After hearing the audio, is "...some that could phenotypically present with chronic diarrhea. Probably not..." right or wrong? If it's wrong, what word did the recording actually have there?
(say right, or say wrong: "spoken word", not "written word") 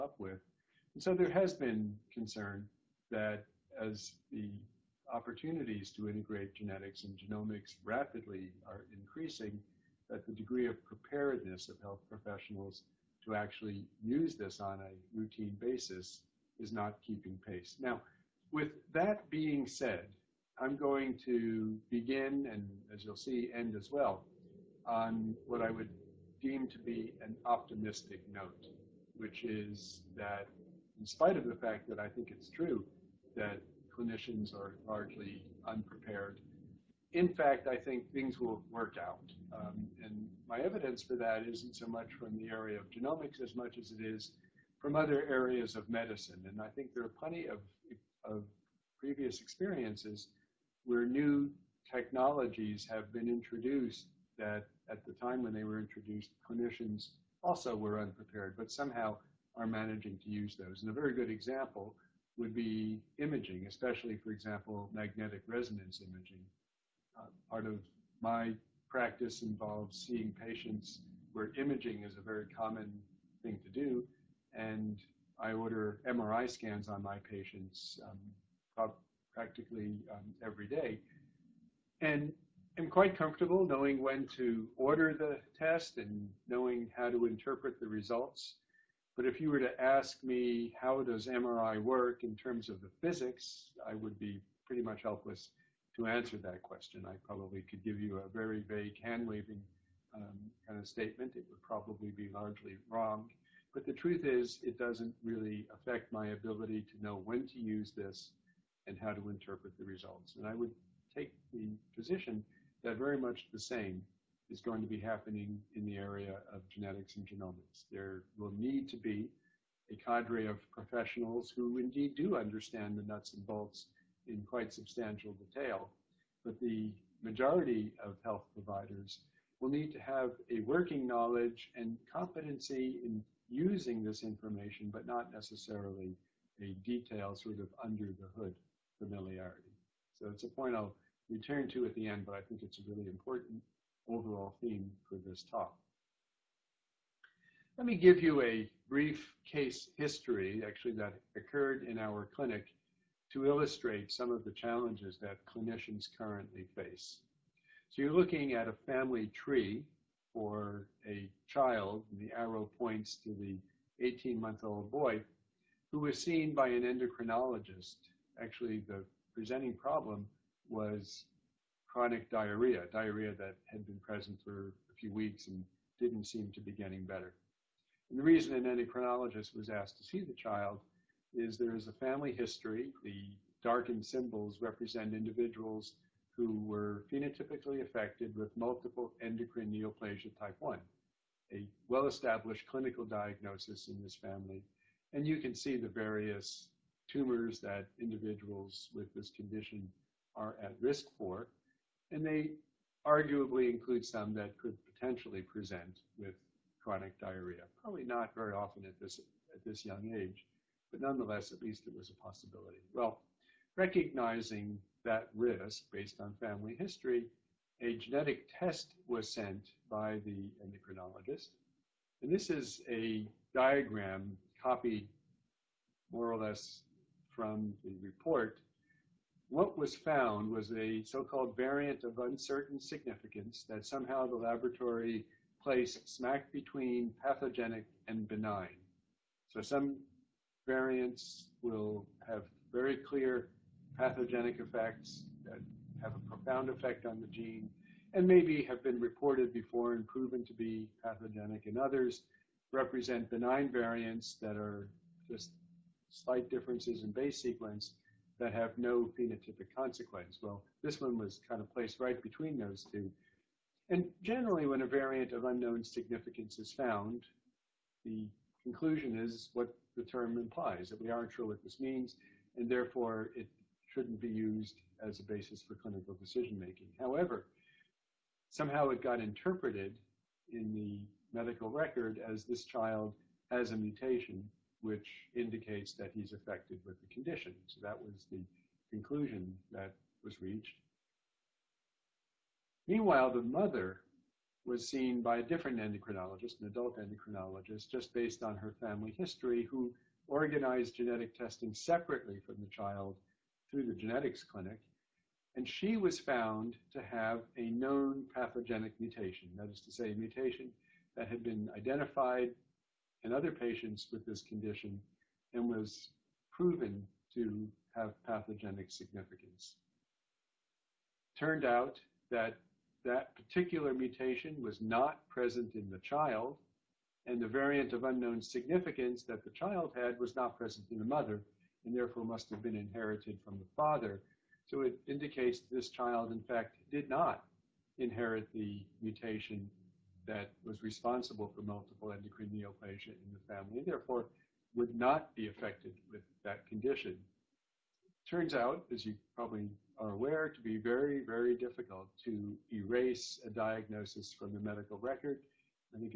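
wrong: "potentially", not "phenotypically".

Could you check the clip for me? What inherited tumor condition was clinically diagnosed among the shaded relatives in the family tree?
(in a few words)
Multiple endocrine neoplasia type 1.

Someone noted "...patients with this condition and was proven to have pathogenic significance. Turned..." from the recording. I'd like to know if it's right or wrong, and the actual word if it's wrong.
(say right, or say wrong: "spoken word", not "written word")
right.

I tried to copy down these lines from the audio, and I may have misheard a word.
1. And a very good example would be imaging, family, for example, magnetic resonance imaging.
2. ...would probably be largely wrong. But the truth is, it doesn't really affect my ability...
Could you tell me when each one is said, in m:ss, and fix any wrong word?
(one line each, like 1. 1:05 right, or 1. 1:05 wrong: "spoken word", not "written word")
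1. 1:00 wrong: "especially", not "family"
2. 1:41 right.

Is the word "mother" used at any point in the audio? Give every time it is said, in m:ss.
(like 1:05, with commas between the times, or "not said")
4:53, 5:31.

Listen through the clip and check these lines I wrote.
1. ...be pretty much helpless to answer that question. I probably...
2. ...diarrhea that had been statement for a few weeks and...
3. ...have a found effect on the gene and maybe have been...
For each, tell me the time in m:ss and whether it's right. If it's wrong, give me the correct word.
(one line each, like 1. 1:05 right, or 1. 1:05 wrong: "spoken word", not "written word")
1. 1:34 right
2. 2:52 wrong: "present", not "statement"
3. 4:06 wrong: "profound", not "found".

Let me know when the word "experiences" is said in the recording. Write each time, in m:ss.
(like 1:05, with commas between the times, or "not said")
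0:49.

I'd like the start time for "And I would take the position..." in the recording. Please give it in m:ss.
1:50.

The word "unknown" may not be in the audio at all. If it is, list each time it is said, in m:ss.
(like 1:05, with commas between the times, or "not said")
4:25, 5:28.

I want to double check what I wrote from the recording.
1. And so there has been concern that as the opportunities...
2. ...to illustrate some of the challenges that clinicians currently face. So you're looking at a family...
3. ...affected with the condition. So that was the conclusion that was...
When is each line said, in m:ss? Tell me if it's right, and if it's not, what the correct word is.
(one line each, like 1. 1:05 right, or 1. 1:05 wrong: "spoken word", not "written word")
1. 0:00 right
2. 2:33 right
3. 4:46 right.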